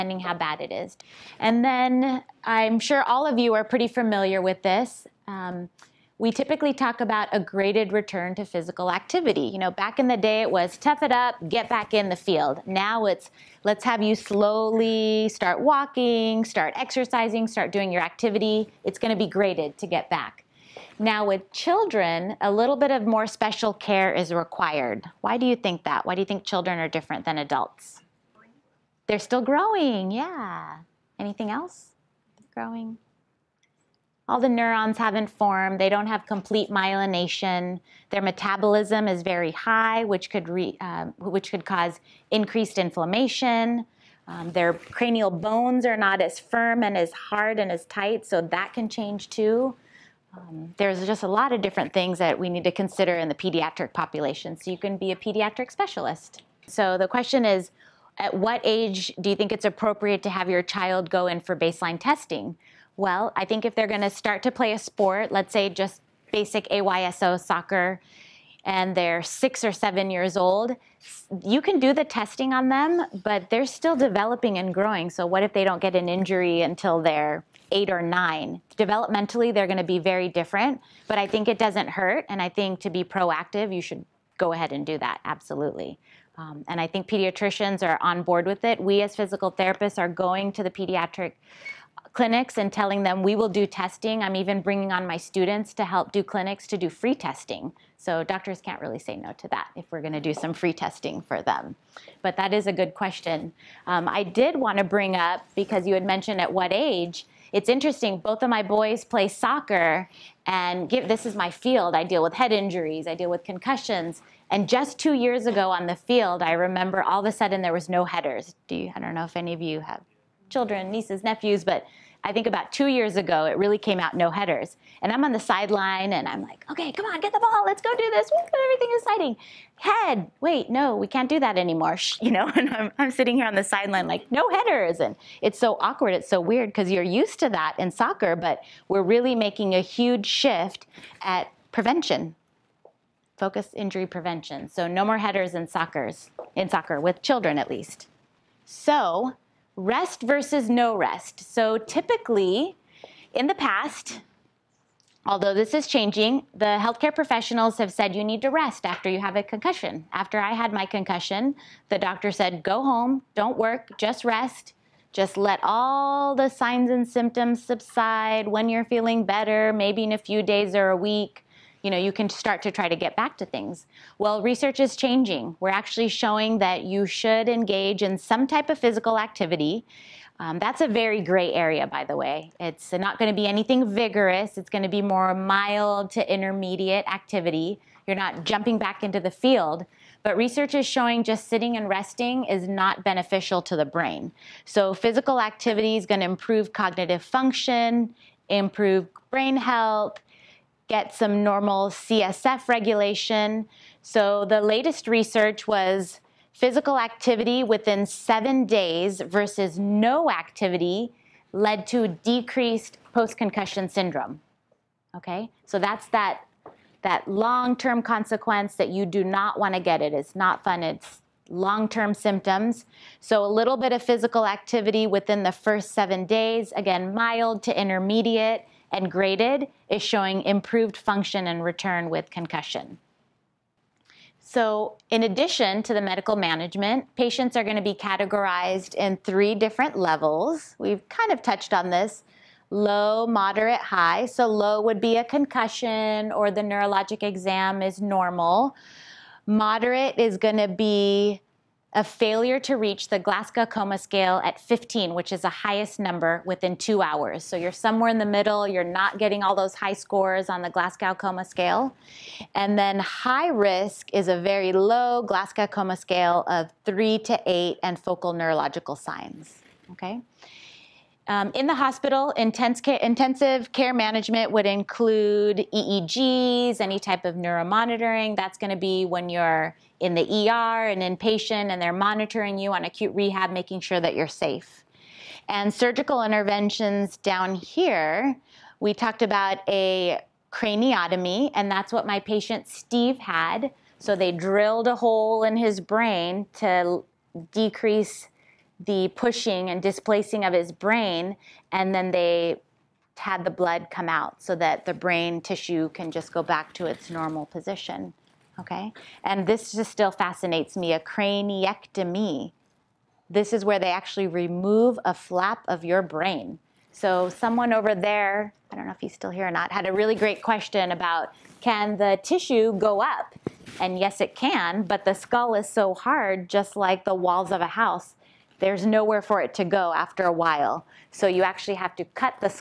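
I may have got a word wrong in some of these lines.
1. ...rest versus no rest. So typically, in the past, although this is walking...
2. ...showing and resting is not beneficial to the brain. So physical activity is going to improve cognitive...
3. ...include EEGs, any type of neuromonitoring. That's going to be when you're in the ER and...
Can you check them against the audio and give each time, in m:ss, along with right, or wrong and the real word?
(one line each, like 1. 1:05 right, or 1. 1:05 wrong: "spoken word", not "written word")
1. 2:29 wrong: "changing", not "walking"
2. 3:11 wrong: "sitting", not "showing"
3. 4:34 right.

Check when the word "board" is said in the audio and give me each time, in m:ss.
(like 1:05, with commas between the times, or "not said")
1:28.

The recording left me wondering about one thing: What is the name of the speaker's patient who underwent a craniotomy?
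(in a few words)
Steve.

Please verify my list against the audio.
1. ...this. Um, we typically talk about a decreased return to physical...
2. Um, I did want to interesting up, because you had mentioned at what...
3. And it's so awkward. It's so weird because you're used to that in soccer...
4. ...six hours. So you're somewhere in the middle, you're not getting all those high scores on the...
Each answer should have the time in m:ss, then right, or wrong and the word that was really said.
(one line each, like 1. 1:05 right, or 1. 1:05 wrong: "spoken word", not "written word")
1. 0:04 wrong: "graded", not "decreased"
2. 1:43 wrong: "bring", not "interesting"
3. 2:15 right
4. 4:16 wrong: "two", not "six".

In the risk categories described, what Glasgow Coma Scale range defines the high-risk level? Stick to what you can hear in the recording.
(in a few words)
3 to 8.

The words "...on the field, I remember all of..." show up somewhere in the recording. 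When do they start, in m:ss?
1:55.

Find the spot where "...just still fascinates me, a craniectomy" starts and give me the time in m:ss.
5:09.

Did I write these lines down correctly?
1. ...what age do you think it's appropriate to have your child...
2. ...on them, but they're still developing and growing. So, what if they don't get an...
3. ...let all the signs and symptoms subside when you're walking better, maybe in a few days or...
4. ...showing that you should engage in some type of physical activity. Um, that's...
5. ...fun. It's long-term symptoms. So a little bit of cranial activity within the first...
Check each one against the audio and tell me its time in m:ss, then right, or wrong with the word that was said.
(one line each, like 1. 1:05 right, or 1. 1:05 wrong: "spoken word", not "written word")
1. 0:58 right
2. 1:12 right
3. 2:45 wrong: "feeling", not "walking"
4. 2:56 right
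5. 3:40 wrong: "physical", not "cranial".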